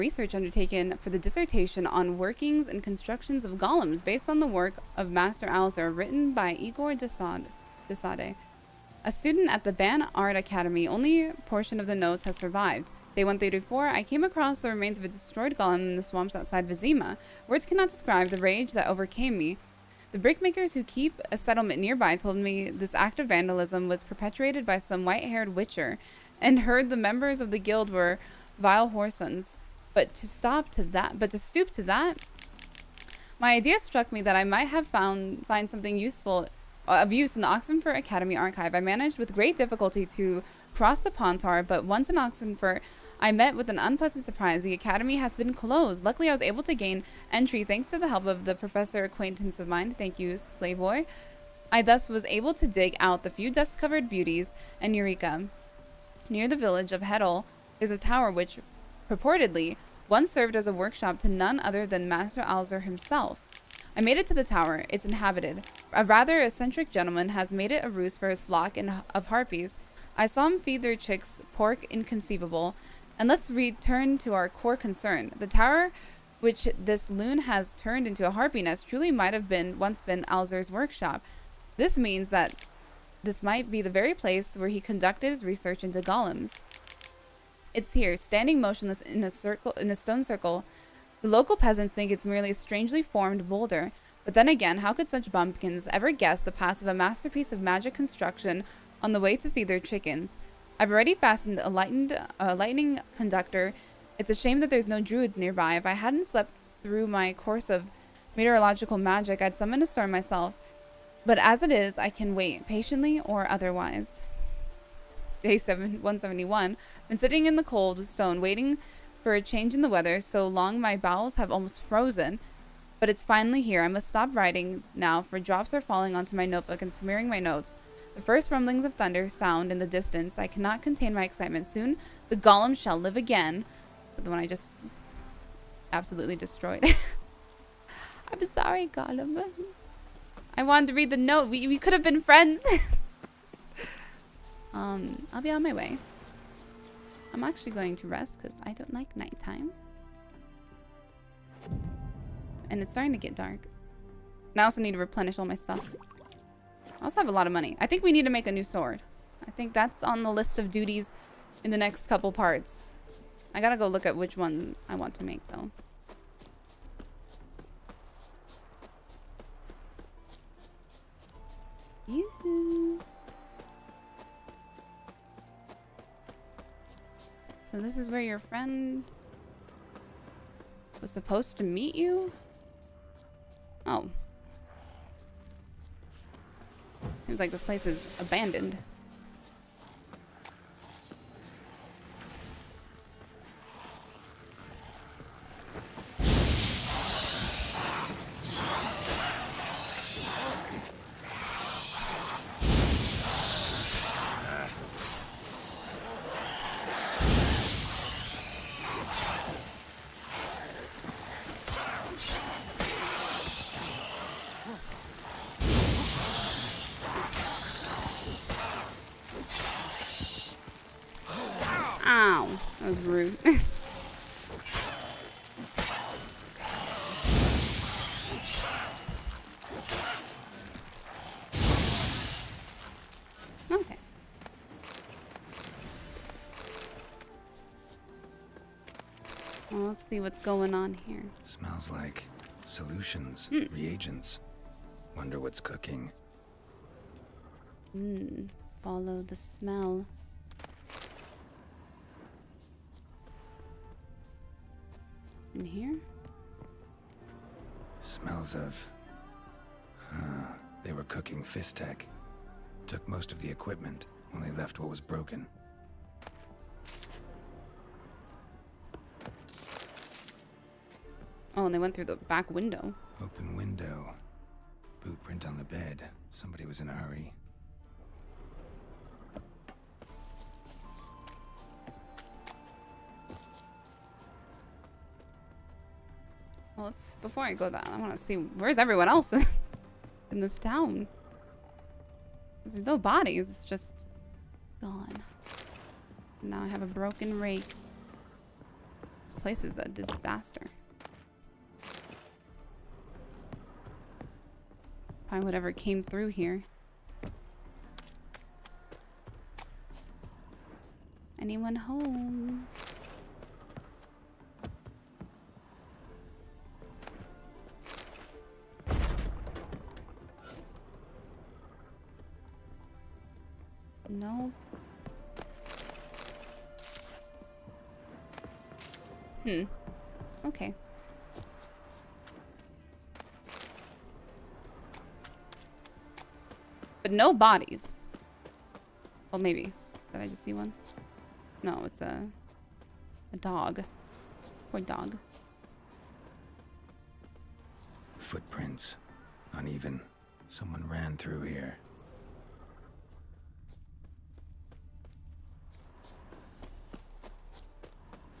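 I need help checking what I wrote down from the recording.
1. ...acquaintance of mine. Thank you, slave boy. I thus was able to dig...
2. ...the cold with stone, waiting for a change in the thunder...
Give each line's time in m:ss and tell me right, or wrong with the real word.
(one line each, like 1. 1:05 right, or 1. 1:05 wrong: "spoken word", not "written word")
1. 0:49 right
2. 1:57 wrong: "weather", not "thunder".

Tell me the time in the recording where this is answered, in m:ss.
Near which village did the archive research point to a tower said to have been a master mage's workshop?
0:57.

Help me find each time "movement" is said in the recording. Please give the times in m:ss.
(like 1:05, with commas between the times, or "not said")
not said.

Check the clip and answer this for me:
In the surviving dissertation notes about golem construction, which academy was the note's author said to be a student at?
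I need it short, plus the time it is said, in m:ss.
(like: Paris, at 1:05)
Ban Ard Academy, at 0:09.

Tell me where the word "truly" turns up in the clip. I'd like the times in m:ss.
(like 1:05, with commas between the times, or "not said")
1:18.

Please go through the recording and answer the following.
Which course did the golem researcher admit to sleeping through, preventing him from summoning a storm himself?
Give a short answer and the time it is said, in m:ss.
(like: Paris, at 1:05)
Meteorological magic, at 1:48.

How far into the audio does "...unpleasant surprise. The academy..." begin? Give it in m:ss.
0:43.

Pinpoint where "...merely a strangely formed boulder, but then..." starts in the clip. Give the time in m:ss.
1:32.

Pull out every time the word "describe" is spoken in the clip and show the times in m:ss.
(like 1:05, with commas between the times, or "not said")
0:17.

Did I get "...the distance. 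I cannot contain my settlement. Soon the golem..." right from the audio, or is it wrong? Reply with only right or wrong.
wrong.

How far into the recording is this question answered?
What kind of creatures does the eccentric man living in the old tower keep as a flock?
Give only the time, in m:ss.
1:09.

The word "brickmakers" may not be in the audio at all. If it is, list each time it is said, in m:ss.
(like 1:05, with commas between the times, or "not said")
0:20.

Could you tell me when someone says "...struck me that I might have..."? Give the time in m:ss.
0:33.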